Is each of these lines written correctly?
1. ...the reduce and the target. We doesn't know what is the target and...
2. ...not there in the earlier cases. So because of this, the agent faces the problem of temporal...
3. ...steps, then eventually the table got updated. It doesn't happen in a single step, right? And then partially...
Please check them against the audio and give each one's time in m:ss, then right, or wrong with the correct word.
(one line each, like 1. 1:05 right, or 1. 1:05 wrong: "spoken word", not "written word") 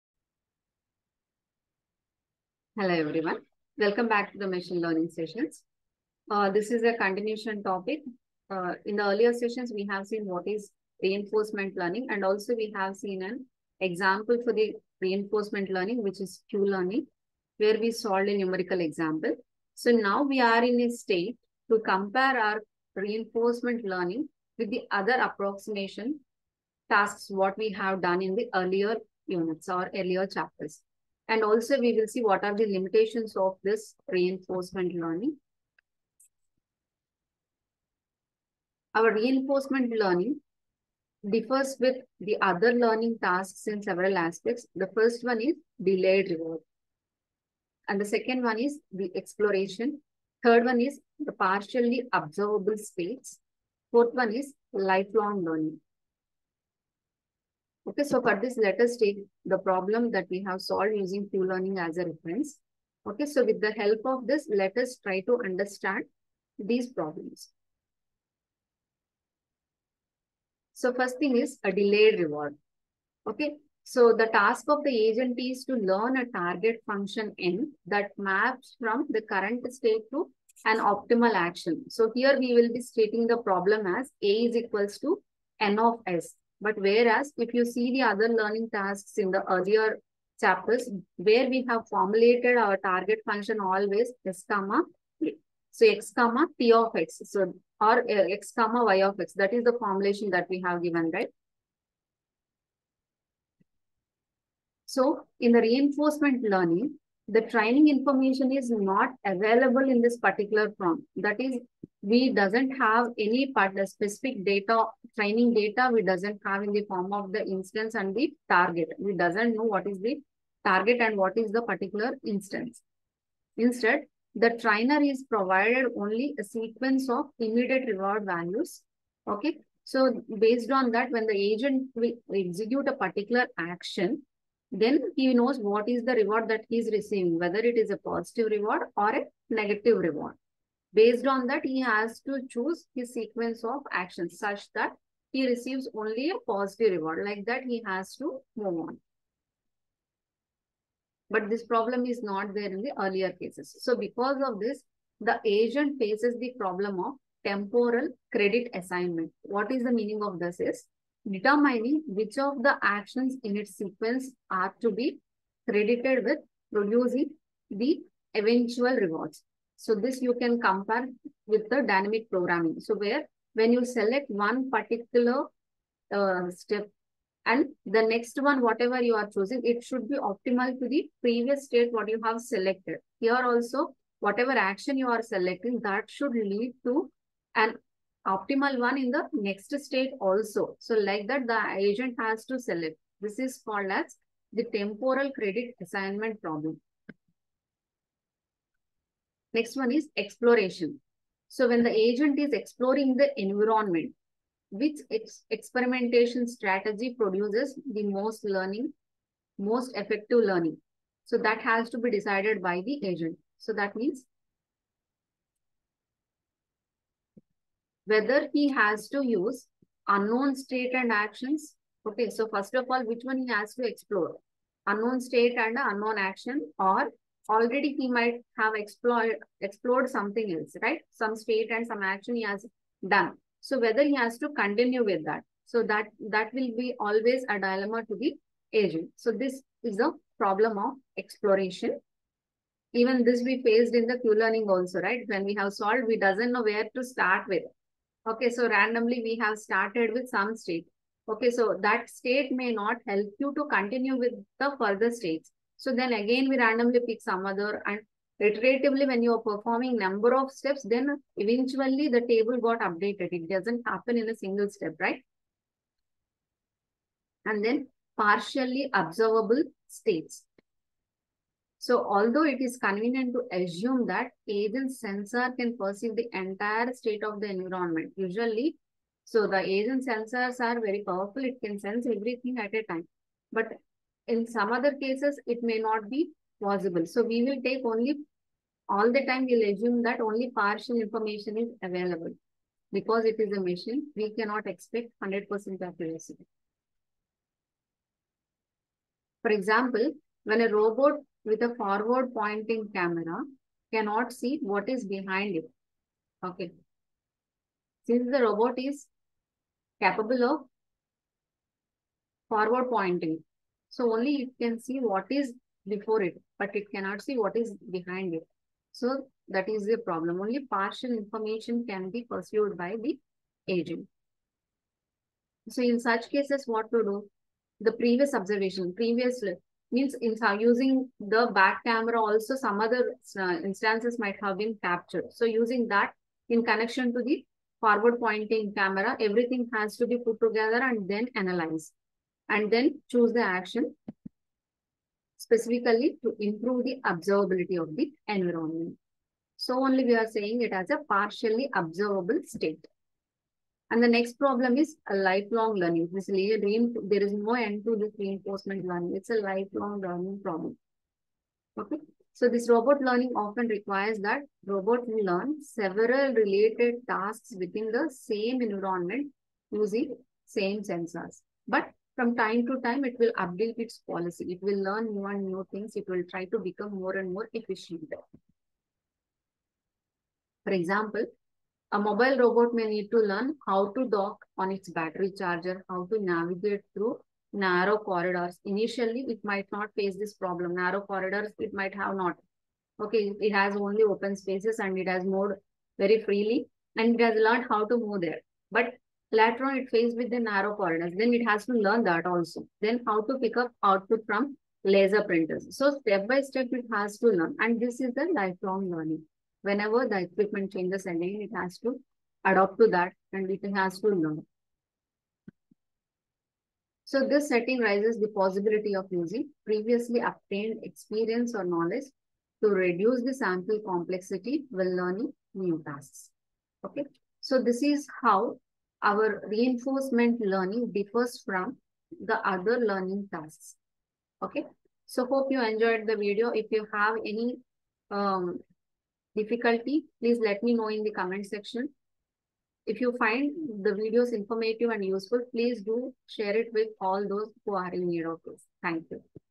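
1. 1:57 wrong: "instance", not "reduce"
2. 2:32 right
3. 4:20 right.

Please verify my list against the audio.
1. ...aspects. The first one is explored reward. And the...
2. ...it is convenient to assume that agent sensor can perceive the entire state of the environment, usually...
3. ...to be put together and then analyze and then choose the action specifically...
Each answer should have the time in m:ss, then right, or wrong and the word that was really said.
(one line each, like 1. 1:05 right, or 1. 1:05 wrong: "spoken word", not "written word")
1. 0:44 wrong: "delayed", not "explored"
2. 4:32 right
3. 5:39 right.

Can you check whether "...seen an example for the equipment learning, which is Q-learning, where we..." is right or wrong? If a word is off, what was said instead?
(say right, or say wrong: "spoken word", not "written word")
wrong: "reinforcement", not "equipment".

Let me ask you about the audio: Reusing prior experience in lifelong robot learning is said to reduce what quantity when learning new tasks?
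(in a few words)
sample complexity.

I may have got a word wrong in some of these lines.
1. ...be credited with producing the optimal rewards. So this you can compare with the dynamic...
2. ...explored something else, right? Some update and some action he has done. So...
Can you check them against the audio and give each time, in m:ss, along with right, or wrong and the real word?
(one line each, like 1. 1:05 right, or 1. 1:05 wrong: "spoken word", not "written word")
1. 2:44 wrong: "eventual", not "optimal"
2. 3:49 wrong: "state", not "update".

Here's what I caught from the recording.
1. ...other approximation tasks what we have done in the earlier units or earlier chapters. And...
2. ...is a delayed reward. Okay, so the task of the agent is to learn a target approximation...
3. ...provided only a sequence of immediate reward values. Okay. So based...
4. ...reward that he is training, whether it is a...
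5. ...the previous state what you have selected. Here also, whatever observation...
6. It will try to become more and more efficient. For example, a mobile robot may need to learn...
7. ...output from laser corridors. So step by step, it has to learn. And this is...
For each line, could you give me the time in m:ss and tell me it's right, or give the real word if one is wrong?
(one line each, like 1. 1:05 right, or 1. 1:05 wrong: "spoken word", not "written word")
1. 0:24 right
2. 1:11 wrong: "function", not "approximation"
3. 2:05 right
4. 2:16 wrong: "receiving", not "training"
5. 3:00 wrong: "action", not "observation"
6. 6:15 right
7. 6:43 wrong: "printers", not "corridors".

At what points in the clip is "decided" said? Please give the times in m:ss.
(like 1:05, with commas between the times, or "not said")
3:32.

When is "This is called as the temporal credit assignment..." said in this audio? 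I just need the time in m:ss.
3:13.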